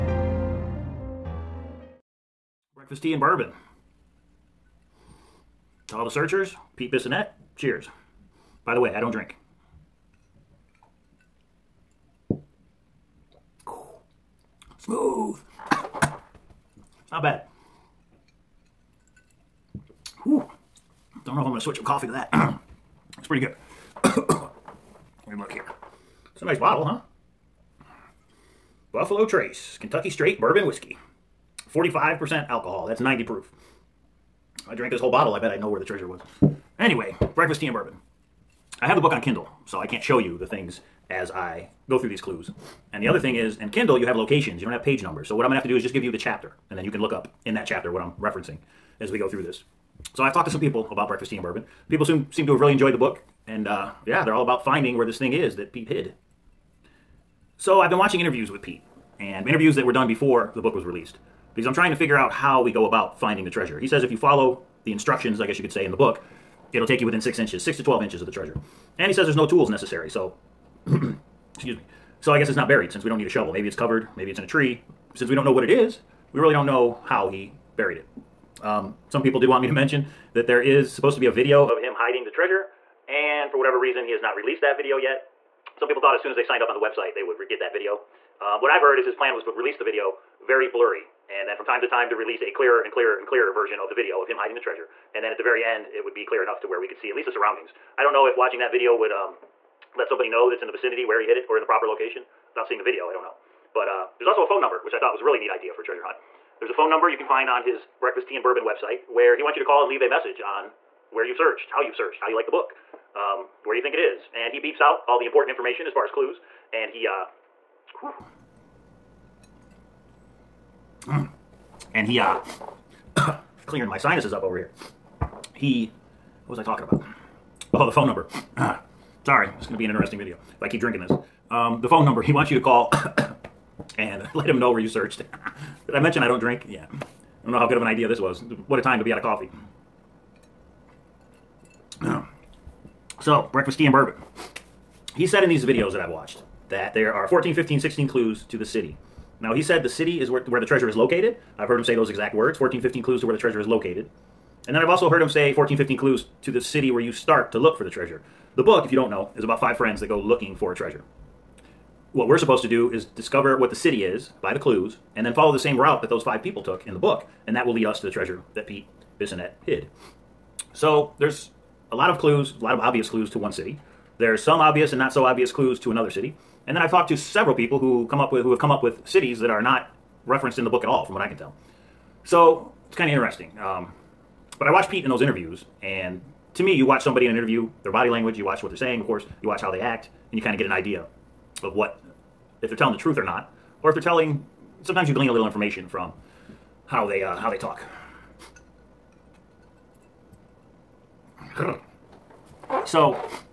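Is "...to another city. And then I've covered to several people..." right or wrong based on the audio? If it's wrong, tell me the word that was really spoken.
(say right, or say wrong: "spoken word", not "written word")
wrong: "talked", not "covered".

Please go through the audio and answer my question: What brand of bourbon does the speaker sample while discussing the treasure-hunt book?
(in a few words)
Buffalo Trace.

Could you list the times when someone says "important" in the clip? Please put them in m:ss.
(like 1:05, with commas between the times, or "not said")
1:55.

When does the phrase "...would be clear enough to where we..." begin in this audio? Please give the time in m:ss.
1:36.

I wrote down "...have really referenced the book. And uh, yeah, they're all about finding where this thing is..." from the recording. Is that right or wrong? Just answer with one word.
wrong.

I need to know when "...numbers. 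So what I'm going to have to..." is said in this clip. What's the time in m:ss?
0:45.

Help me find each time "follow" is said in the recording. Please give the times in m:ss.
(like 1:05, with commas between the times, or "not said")
1:04, 2:45.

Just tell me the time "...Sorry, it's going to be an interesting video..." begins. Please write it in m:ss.
2:09.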